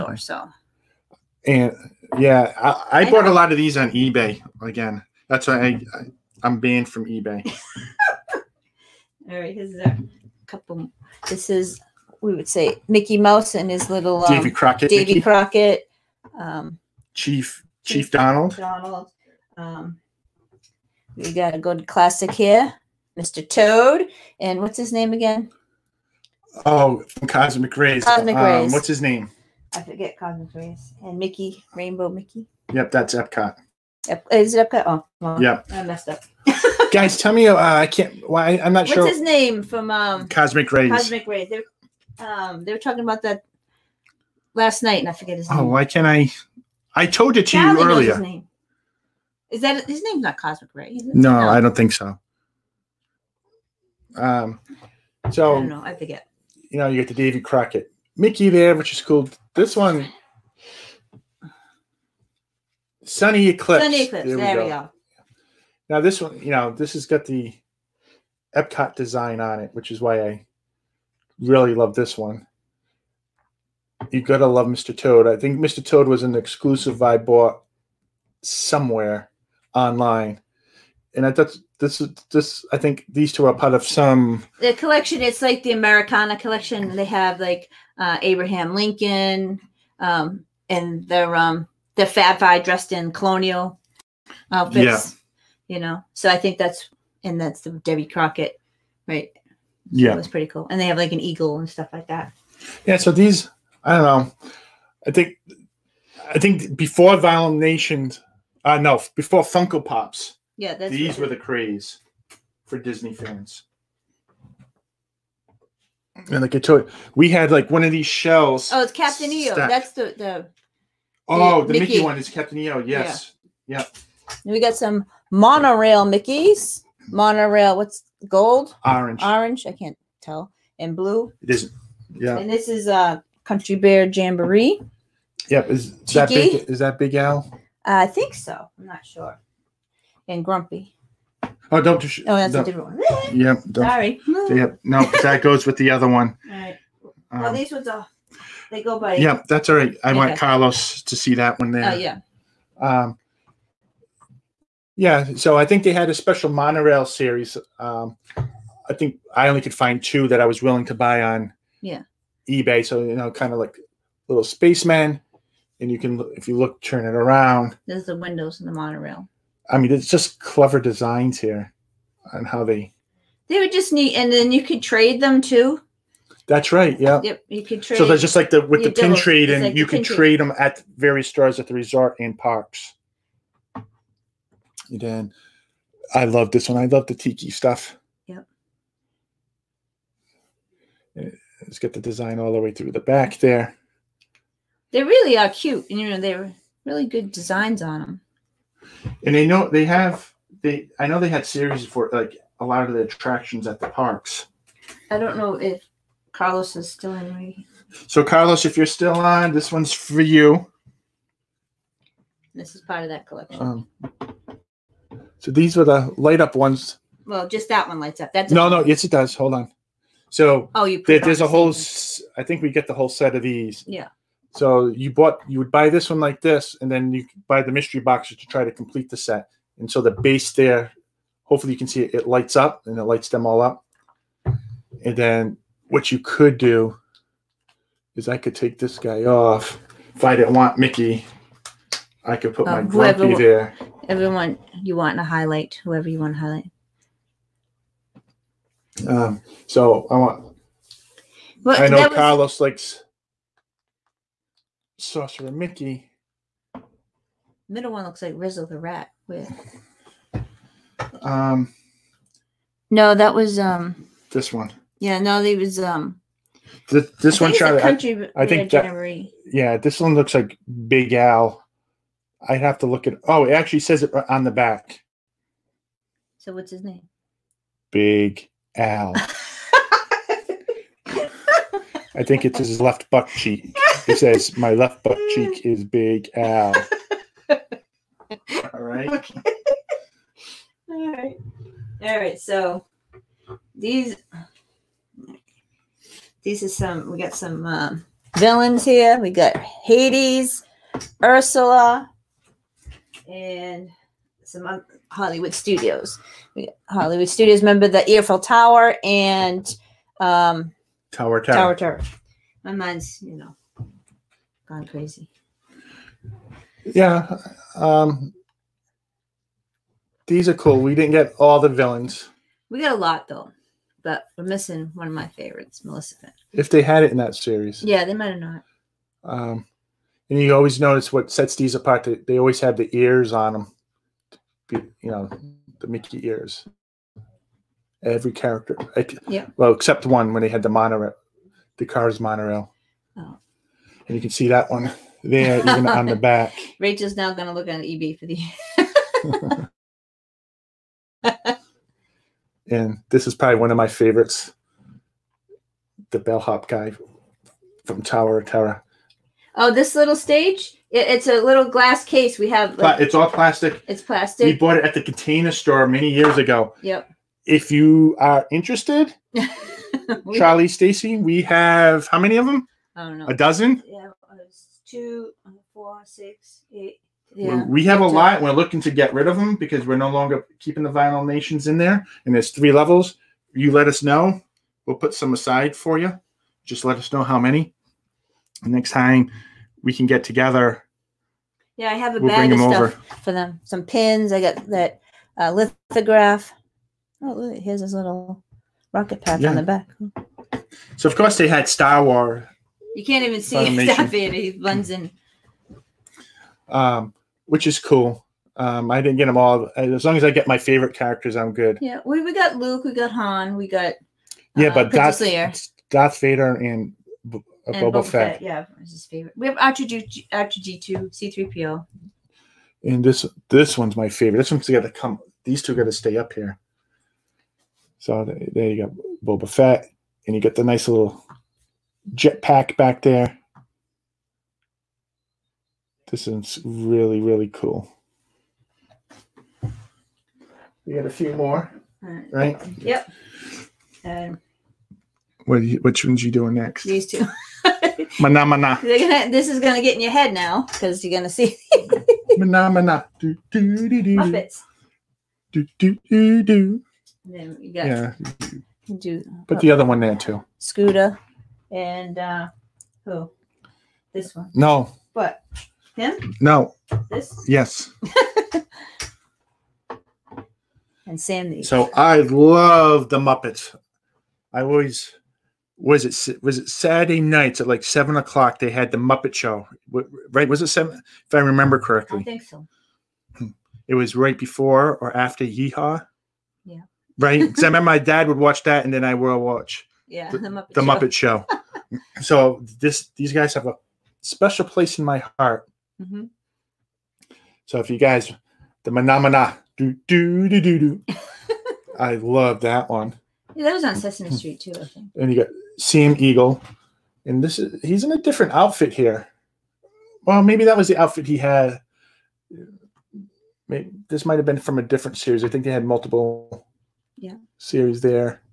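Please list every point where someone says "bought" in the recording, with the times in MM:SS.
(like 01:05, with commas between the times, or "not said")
00:03, 01:17, 03:45, 06:04.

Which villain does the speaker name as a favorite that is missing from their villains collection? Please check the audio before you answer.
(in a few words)
Finn.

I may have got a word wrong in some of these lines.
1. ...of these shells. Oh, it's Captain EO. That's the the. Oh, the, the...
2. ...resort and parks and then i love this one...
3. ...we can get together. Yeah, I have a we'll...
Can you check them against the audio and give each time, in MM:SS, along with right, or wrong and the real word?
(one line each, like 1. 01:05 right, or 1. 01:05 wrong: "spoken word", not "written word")
1. 01:57 right
2. 03:01 right
3. 06:29 right.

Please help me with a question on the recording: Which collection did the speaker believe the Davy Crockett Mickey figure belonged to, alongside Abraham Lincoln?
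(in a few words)
Americana collection.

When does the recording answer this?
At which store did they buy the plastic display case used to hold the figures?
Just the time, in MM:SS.
06:05.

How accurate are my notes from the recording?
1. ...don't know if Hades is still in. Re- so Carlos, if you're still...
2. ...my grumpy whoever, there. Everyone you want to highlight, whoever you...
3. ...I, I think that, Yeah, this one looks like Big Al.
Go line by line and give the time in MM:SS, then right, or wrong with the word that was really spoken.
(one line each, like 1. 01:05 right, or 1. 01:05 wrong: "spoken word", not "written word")
1. 03:25 wrong: "Carlos", not "Hades"
2. 04:02 right
3. 04:28 right.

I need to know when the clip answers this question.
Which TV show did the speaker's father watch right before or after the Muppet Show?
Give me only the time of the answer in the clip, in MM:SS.
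08:05.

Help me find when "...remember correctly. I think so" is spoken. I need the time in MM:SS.
08:01.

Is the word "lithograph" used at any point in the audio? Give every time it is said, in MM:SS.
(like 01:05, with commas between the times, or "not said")
06:35.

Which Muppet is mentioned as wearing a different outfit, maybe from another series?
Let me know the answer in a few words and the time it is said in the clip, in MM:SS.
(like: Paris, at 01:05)
Sam Eagle, at 08:25.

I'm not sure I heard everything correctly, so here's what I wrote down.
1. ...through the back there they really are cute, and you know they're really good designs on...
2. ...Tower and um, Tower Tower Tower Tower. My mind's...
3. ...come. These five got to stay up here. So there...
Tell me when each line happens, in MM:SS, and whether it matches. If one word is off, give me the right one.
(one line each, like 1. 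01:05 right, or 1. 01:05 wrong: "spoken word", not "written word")
1. 03:12 right
2. 05:08 right
3. 07:04 wrong: "two", not "five".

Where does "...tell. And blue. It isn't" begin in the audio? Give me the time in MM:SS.
02:10.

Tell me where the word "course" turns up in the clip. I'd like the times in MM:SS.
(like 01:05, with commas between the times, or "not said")
06:41.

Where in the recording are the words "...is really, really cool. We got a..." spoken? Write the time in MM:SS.
07:16.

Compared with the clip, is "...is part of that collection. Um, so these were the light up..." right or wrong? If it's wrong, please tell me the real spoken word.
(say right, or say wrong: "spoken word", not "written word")
right.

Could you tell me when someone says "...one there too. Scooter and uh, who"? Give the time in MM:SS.
07:39.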